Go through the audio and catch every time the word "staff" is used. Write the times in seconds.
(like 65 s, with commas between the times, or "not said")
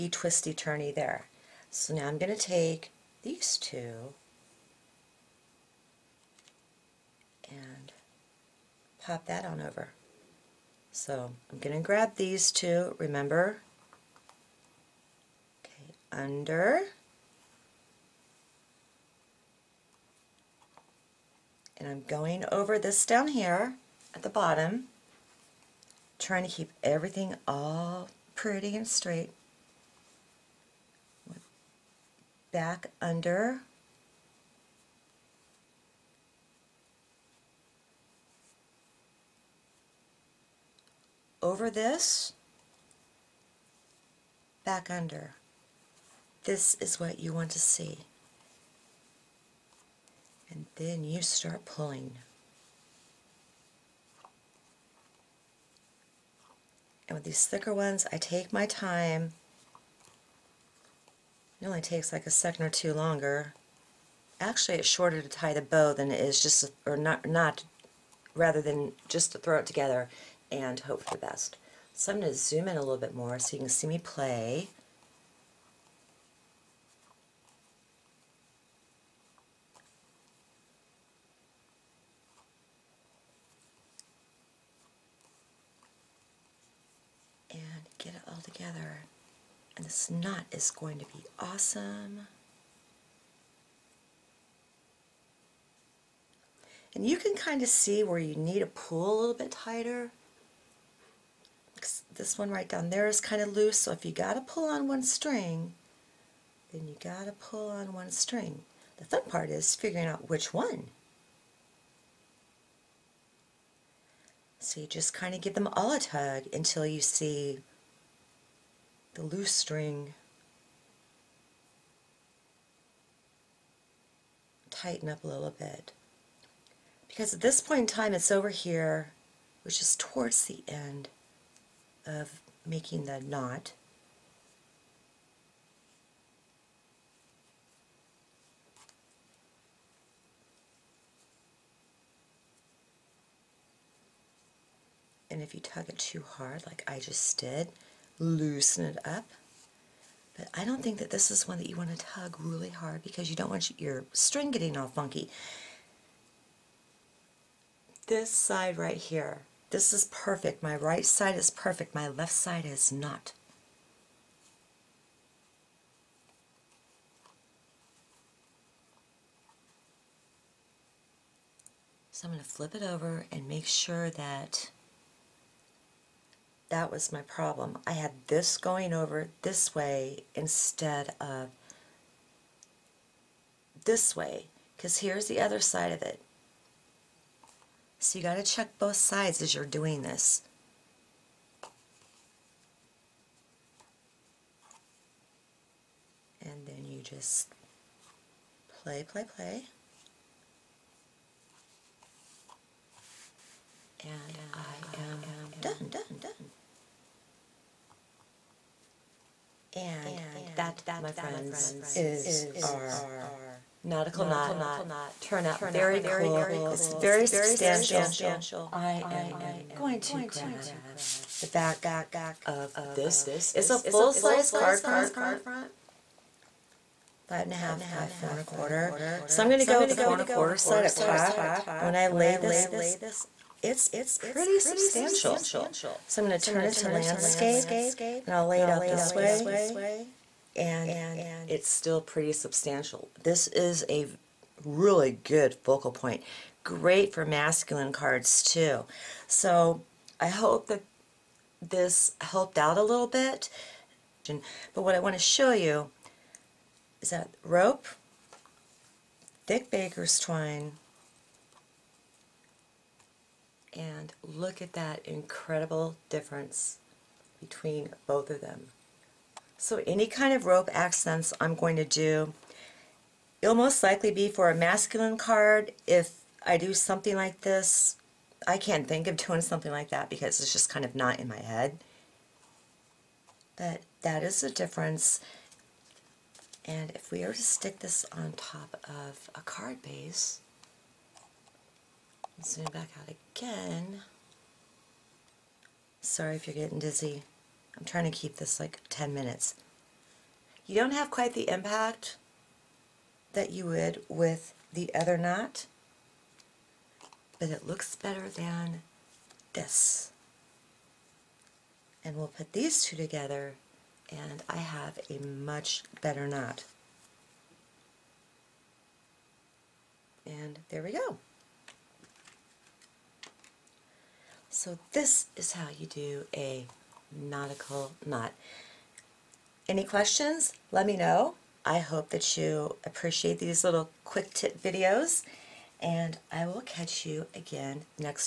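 not said.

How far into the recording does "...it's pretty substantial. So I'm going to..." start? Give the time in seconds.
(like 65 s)
233 s.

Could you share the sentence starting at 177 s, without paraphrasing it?
I had this going over this way instead of this way because here's the other side of it.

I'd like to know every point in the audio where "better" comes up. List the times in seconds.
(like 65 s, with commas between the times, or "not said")
307 s, 316 s.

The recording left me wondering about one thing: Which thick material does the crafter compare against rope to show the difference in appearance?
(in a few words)
thick baker's twine.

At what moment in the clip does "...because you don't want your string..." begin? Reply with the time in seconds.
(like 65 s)
153 s.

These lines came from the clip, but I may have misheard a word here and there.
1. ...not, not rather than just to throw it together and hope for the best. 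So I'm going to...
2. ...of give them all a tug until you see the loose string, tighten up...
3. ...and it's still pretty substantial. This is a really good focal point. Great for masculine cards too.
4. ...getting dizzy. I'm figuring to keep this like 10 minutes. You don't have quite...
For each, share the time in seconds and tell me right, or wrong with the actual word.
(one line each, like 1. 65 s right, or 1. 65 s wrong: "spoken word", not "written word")
1. 66 s right
2. 115 s right
3. 240 s right
4. 296 s wrong: "trying", not "figuring".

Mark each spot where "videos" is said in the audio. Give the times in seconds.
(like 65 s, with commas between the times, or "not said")
334 s.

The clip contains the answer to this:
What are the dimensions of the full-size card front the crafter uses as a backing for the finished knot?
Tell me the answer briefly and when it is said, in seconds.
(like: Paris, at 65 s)
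5 1/2 by 4 1/4, at 227 s.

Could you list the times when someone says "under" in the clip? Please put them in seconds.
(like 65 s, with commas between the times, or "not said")
16 s, 33 s, 44 s.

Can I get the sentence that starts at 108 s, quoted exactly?
The fun part is figuring out which one.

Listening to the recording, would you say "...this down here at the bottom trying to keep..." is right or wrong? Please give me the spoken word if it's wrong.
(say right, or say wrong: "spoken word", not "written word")
right.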